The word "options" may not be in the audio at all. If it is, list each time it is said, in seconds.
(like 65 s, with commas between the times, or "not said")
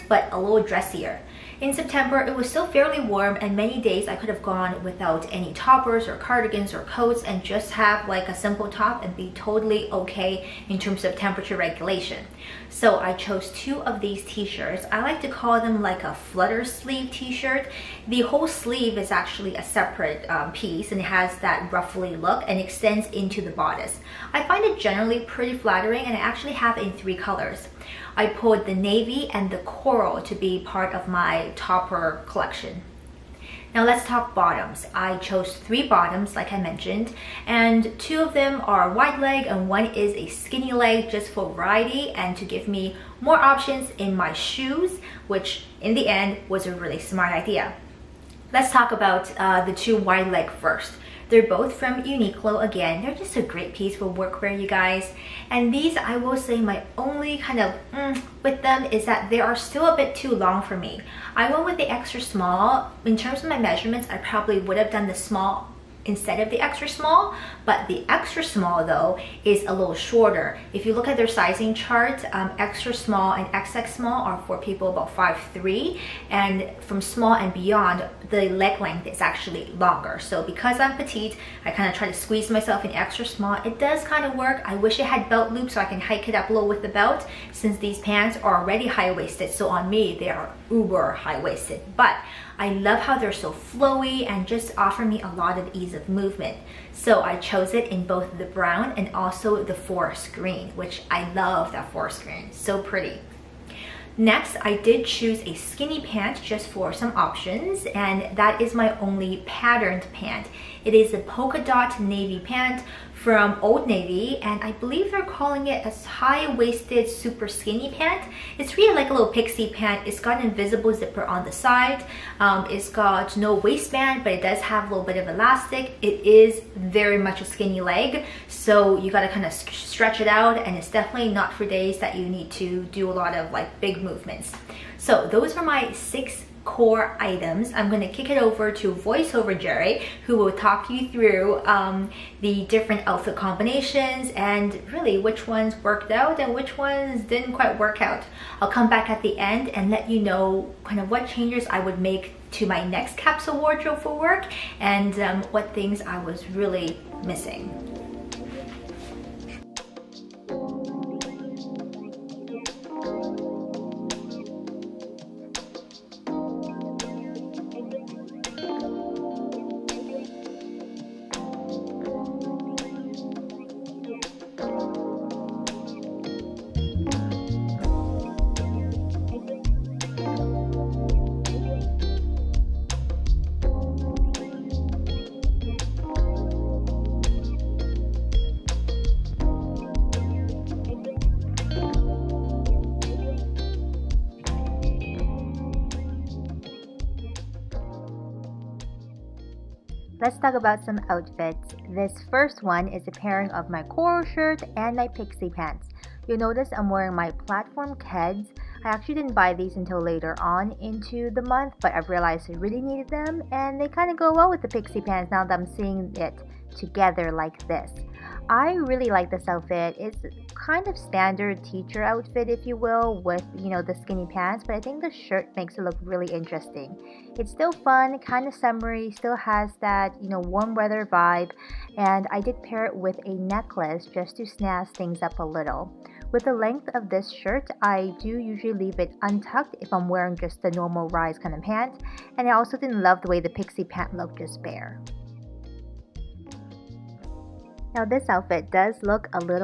43 s, 107 s.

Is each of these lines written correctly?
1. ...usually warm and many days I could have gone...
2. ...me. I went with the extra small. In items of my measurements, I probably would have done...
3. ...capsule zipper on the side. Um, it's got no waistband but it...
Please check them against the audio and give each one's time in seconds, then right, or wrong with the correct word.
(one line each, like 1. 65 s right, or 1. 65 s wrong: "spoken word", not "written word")
1. 2 s wrong: "fairly", not "usually"
2. 60 s wrong: "terms", not "items"
3. 120 s wrong: "invisible", not "capsule".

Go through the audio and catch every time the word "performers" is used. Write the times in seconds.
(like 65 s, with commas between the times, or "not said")
not said.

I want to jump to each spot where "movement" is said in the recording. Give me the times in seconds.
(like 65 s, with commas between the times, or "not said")
96 s, 134 s.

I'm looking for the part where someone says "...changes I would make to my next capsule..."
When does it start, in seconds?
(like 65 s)
151 s.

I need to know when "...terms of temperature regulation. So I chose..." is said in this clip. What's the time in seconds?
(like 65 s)
10 s.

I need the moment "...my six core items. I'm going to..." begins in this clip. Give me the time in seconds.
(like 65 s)
135 s.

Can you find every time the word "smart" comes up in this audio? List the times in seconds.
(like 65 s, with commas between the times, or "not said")
46 s.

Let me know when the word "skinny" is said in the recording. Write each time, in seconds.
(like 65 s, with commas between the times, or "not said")
40 s, 105 s, 117 s, 127 s, 223 s.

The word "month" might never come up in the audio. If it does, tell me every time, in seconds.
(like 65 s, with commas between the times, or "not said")
211 s.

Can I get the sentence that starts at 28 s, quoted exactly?
I pulled the navy and the coral to be part of my topper collection.